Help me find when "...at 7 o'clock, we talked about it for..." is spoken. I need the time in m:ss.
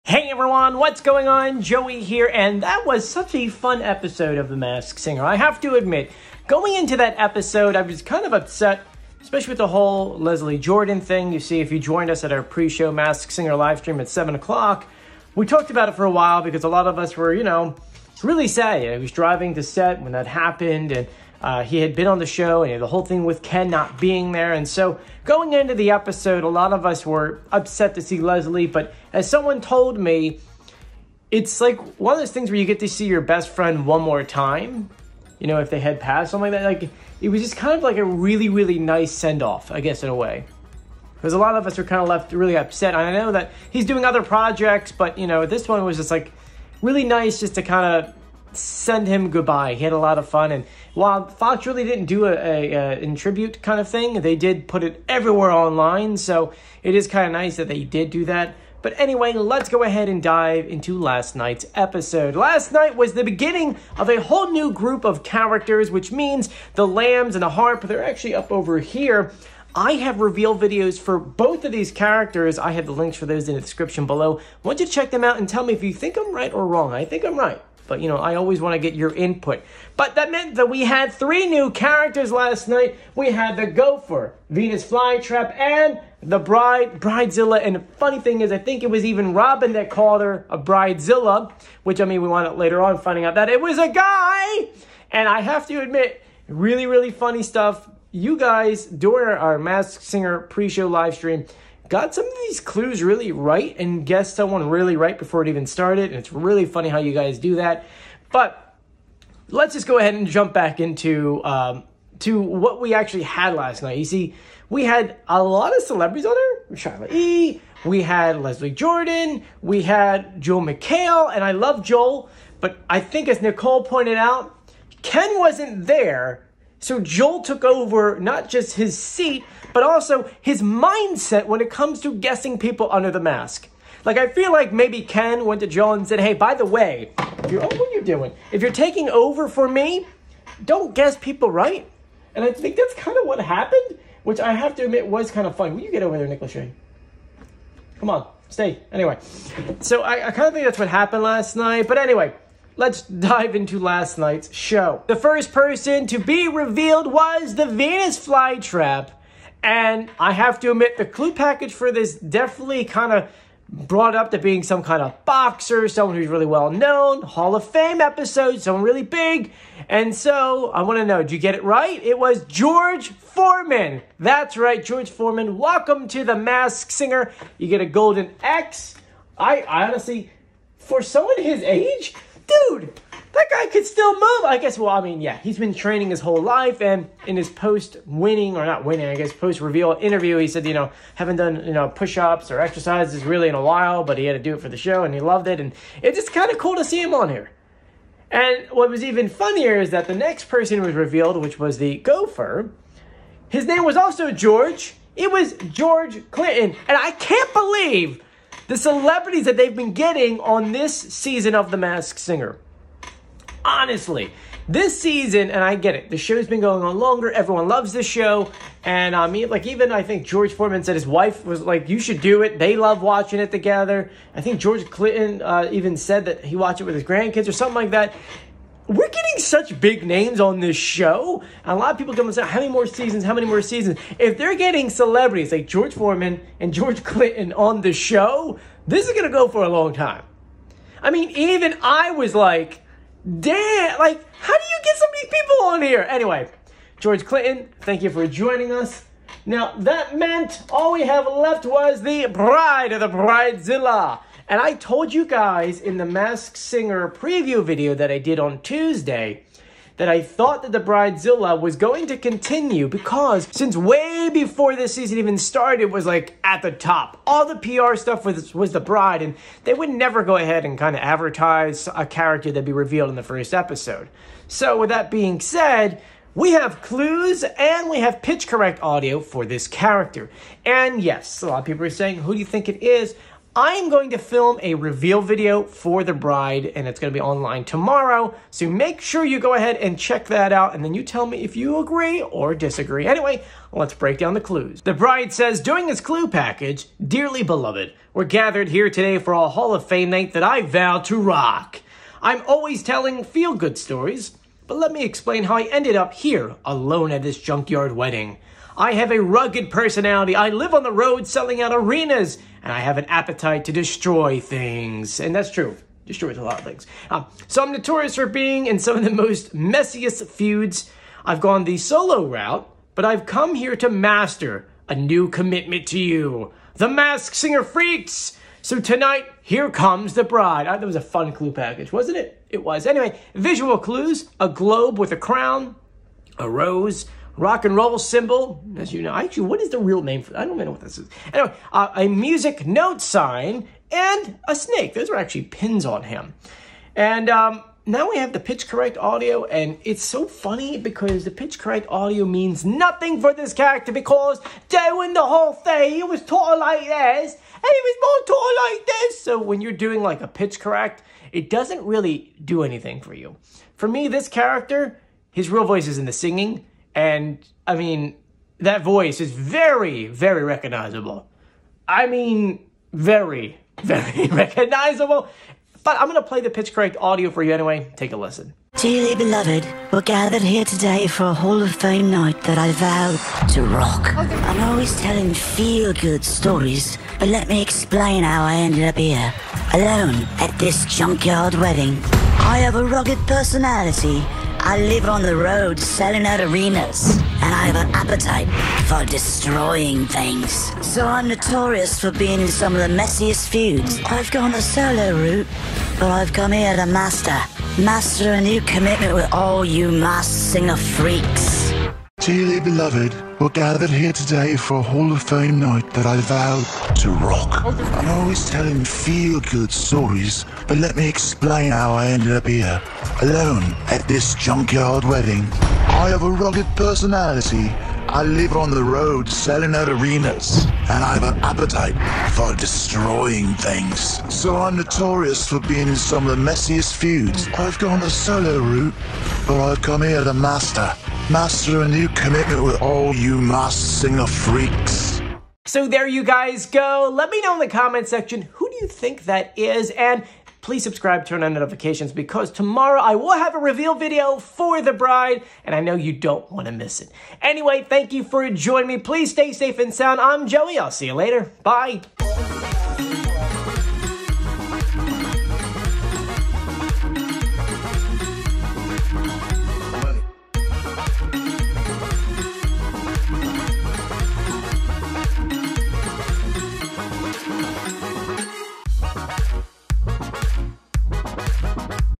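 0:13.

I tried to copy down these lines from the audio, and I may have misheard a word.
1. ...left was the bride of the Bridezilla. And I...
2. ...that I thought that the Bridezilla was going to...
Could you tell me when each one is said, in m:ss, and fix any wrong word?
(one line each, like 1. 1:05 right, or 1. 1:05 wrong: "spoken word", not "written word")
1. 4:11 right
2. 4:19 right.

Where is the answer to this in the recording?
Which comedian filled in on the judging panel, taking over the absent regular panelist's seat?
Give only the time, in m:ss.
2:00.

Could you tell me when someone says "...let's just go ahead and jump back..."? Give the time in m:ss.
1:49.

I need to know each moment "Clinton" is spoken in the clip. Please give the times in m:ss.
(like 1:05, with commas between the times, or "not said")
3:26, 3:44, 3:57, 4:07.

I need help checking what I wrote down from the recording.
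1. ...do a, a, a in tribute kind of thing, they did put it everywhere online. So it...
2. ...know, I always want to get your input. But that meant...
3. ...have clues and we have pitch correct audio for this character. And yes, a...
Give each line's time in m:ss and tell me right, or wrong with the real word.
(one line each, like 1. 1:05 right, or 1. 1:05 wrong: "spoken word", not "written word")
1. 0:52 right
2. 1:18 right
3. 4:36 right.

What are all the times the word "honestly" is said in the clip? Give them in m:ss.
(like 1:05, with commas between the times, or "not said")
2:59, 3:33.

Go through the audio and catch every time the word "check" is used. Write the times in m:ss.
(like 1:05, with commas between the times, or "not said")
1:14, 4:49.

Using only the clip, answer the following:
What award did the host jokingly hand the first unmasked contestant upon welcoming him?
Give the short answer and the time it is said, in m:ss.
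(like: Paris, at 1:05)
a golden X, at 2:57.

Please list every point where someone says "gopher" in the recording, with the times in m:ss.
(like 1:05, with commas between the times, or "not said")
1:23, 3:21.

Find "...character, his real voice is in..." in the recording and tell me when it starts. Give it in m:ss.
6:04.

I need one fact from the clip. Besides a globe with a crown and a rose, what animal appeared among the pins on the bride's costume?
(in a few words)
a snake.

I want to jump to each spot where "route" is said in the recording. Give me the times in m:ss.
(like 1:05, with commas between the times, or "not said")
5:22, 6:45, 7:18.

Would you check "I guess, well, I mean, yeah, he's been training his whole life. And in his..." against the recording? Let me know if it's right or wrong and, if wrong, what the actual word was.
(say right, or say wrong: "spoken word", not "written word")
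right.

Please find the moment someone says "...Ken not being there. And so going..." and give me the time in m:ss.
0:23.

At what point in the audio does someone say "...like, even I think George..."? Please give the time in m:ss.
3:39.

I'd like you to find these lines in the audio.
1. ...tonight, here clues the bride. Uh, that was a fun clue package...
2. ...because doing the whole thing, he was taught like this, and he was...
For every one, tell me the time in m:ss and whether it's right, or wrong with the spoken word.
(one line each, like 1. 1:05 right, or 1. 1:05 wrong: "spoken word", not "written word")
1. 5:28 wrong: "comes", not "clues"
2. 5:53 right.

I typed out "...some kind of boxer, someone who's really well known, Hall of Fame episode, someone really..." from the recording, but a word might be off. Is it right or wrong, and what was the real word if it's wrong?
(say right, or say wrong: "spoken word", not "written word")
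right.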